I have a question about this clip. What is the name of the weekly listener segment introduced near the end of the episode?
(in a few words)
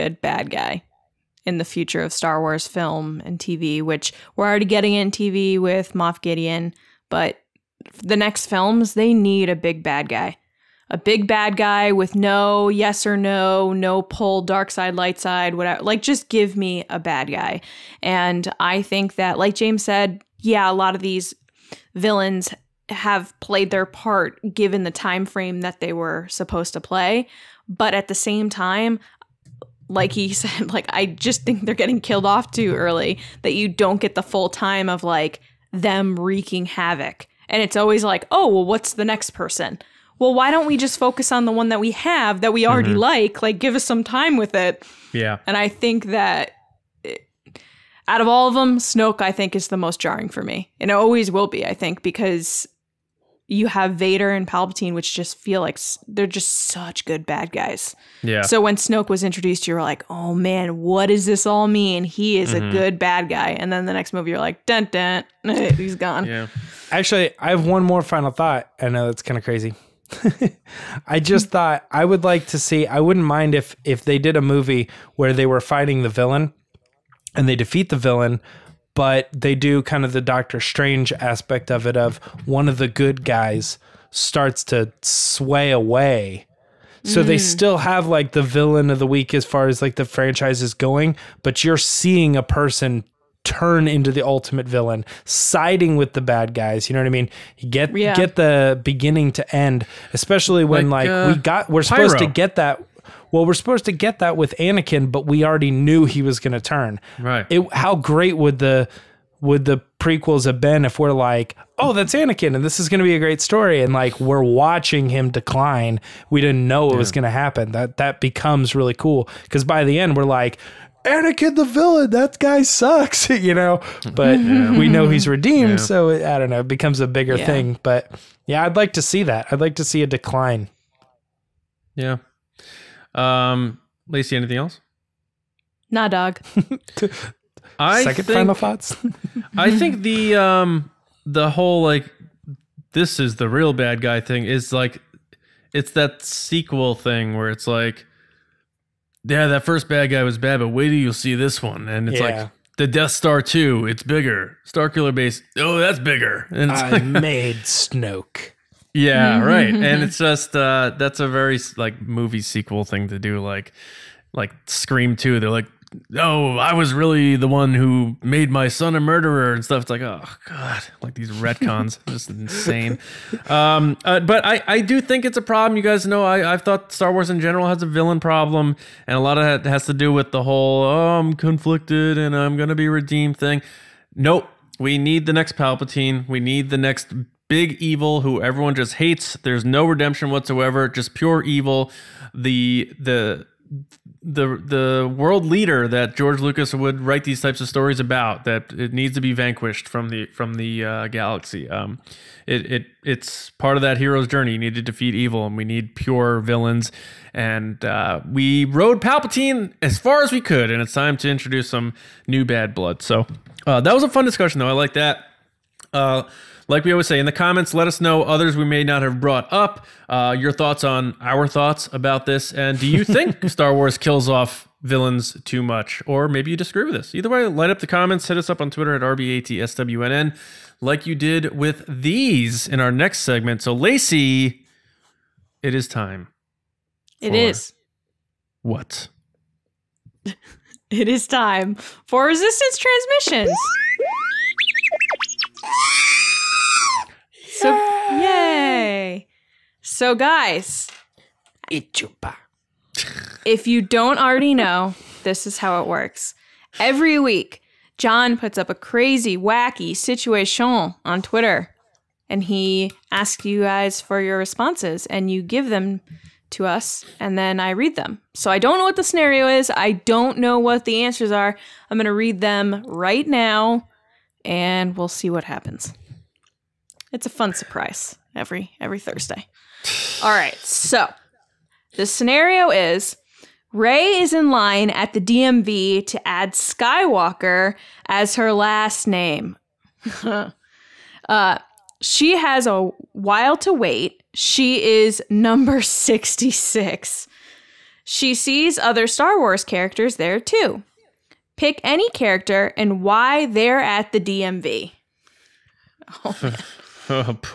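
Resistance Transmissions.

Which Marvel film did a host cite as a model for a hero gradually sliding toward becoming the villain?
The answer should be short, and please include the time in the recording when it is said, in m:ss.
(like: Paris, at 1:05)
Doctor Strange, at 1:20.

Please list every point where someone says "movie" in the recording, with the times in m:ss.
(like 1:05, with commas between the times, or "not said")
1:04, 1:14, 2:42.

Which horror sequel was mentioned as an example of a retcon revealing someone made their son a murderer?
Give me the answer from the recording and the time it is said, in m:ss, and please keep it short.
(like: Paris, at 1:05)
Scream Two, at 2:44.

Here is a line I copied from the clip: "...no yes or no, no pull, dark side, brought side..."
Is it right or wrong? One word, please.
wrong.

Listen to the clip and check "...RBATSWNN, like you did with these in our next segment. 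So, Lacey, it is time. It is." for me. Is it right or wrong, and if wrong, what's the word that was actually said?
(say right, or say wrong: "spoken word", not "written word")
right.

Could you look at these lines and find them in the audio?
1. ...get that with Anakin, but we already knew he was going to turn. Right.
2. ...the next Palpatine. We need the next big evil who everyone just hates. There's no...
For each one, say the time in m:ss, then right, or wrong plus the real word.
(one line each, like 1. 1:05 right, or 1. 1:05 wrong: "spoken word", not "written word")
1. 1:43 right
2. 3:05 right.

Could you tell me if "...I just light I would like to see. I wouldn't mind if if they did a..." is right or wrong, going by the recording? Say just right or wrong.
wrong.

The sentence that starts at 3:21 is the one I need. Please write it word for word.
Um, it it it's part of that hero's journey.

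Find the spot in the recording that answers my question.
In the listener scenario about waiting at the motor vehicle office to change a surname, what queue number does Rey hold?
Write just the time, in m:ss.
4:55.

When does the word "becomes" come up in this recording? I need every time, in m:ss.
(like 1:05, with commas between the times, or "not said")
1:58, 2:06.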